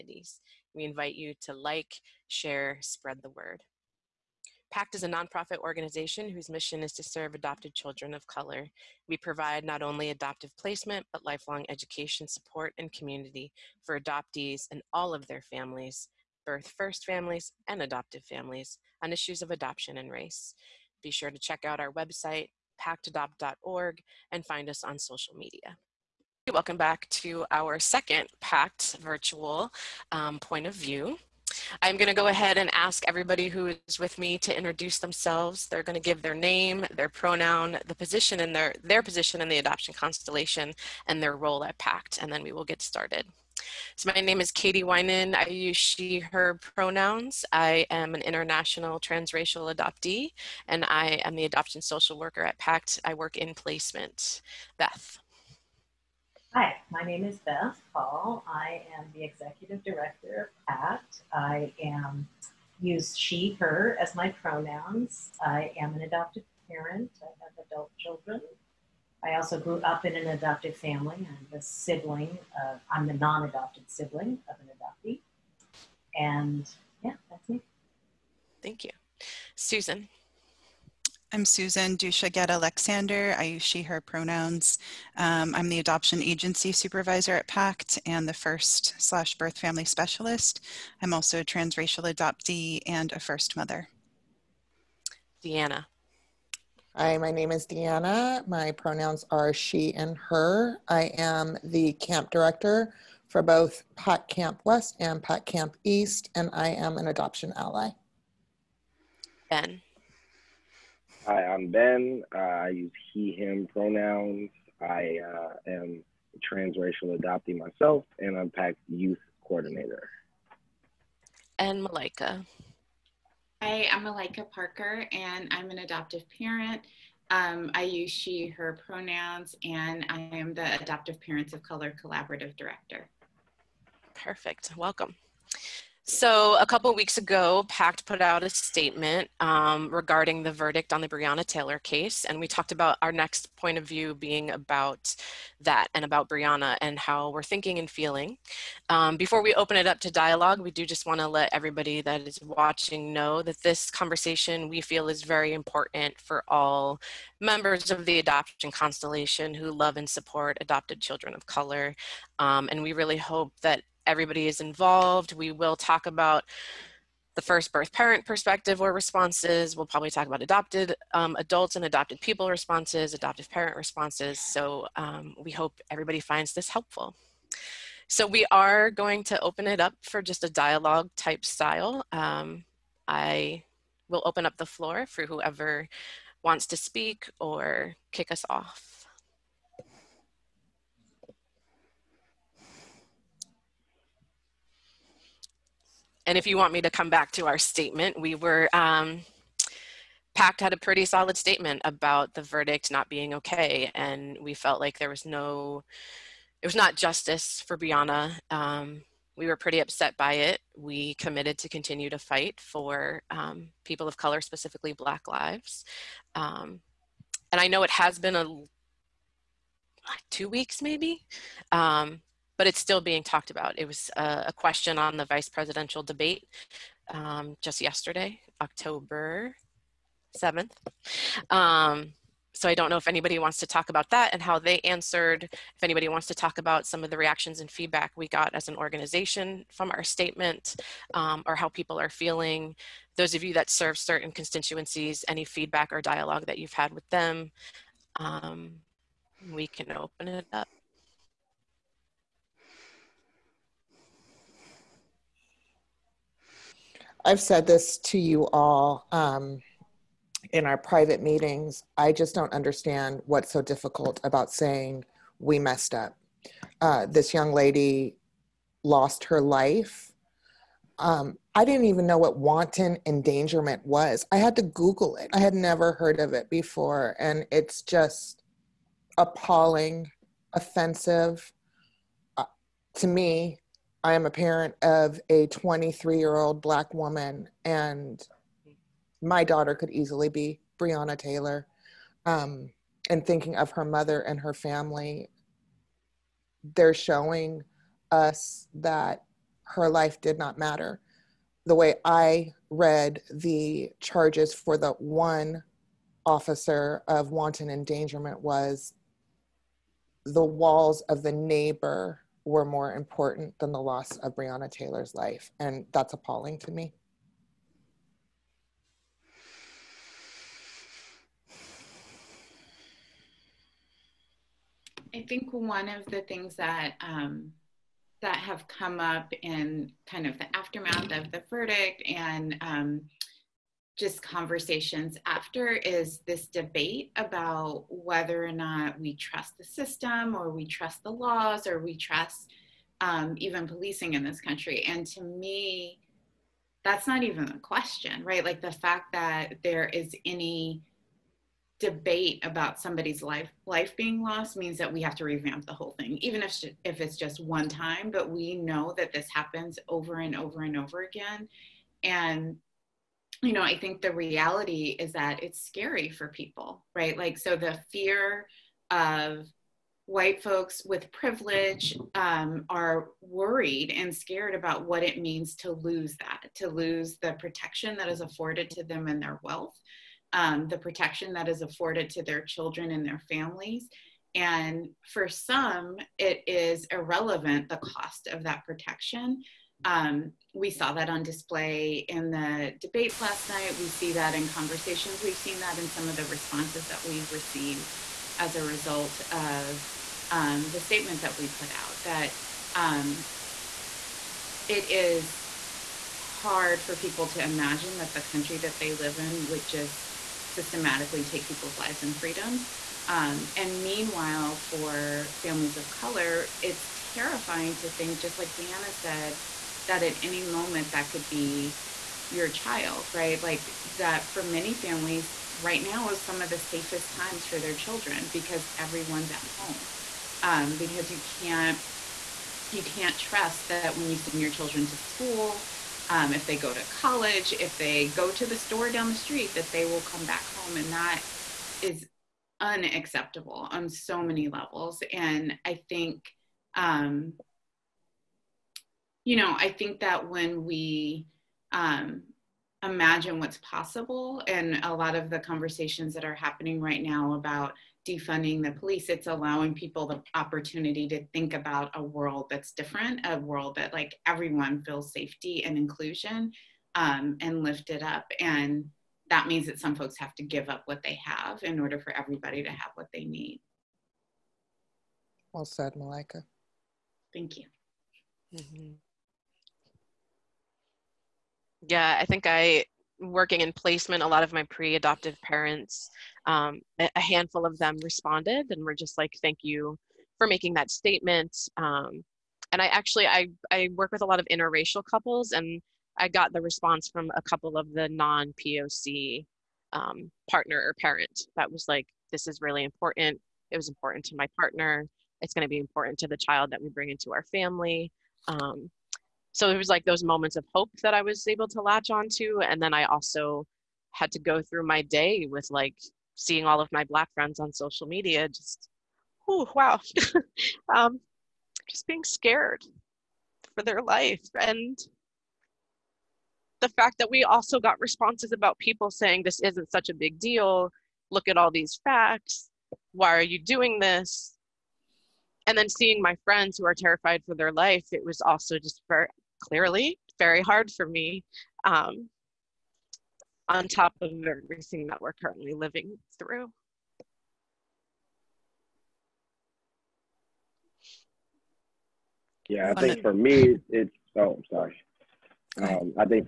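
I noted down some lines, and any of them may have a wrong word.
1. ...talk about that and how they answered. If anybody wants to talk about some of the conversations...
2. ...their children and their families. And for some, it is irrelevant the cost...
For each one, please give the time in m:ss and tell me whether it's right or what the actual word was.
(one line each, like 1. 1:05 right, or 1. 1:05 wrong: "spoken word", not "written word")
1. 3:53 wrong: "reactions", not "conversations"
2. 6:22 right.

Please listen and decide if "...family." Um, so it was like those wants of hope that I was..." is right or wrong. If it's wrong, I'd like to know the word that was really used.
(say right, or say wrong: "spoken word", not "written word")
wrong: "moments", not "wants".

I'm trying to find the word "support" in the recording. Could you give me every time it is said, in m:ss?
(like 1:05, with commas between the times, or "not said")
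0:12, 2:40.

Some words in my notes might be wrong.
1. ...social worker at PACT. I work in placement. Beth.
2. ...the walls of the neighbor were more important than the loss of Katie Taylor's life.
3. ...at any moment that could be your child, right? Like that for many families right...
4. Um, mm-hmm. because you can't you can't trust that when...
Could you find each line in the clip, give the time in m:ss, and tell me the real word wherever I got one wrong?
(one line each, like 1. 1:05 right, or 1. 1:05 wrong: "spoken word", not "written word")
1. 0:51 right
2. 5:10 wrong: "Breonna", not "Katie"
3. 7:00 right
4. 7:10 right.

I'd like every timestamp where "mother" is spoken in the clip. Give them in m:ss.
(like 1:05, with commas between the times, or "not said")
1:33, 4:53.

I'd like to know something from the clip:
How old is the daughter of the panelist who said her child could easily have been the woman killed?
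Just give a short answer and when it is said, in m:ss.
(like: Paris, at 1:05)
23, at 4:45.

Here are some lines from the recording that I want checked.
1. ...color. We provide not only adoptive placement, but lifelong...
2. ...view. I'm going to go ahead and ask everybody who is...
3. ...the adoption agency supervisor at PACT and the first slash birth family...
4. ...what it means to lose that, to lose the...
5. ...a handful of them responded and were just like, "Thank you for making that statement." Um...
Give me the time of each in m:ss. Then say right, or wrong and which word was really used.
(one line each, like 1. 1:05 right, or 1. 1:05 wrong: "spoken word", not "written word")
1. 0:08 right
2. 0:30 right
3. 1:25 right
4. 6:14 right
5. 8:06 right.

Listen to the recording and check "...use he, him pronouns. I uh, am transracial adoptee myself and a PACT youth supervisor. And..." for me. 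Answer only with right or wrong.
wrong.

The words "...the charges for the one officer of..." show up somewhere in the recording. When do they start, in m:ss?
5:03.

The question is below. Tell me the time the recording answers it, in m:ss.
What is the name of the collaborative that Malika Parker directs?
2:10.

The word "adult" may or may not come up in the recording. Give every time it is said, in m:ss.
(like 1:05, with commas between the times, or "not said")
1:07, 2:51.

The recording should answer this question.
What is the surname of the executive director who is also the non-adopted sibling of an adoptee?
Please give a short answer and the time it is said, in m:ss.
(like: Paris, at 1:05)
Paul, at 0:57.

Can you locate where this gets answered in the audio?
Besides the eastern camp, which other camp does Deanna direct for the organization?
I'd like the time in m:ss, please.
1:43.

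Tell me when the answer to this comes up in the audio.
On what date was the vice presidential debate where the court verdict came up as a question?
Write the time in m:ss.
3:48.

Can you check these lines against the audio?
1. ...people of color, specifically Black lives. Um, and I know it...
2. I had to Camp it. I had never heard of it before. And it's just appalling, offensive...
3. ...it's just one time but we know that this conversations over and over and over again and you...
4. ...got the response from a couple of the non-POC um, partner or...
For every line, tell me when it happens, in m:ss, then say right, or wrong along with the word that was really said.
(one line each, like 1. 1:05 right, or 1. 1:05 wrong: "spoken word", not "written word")
1. 3:33 right
2. 4:34 wrong: "Google", not "Camp"
3. 5:57 wrong: "happens", not "conversations"
4. 8:16 right.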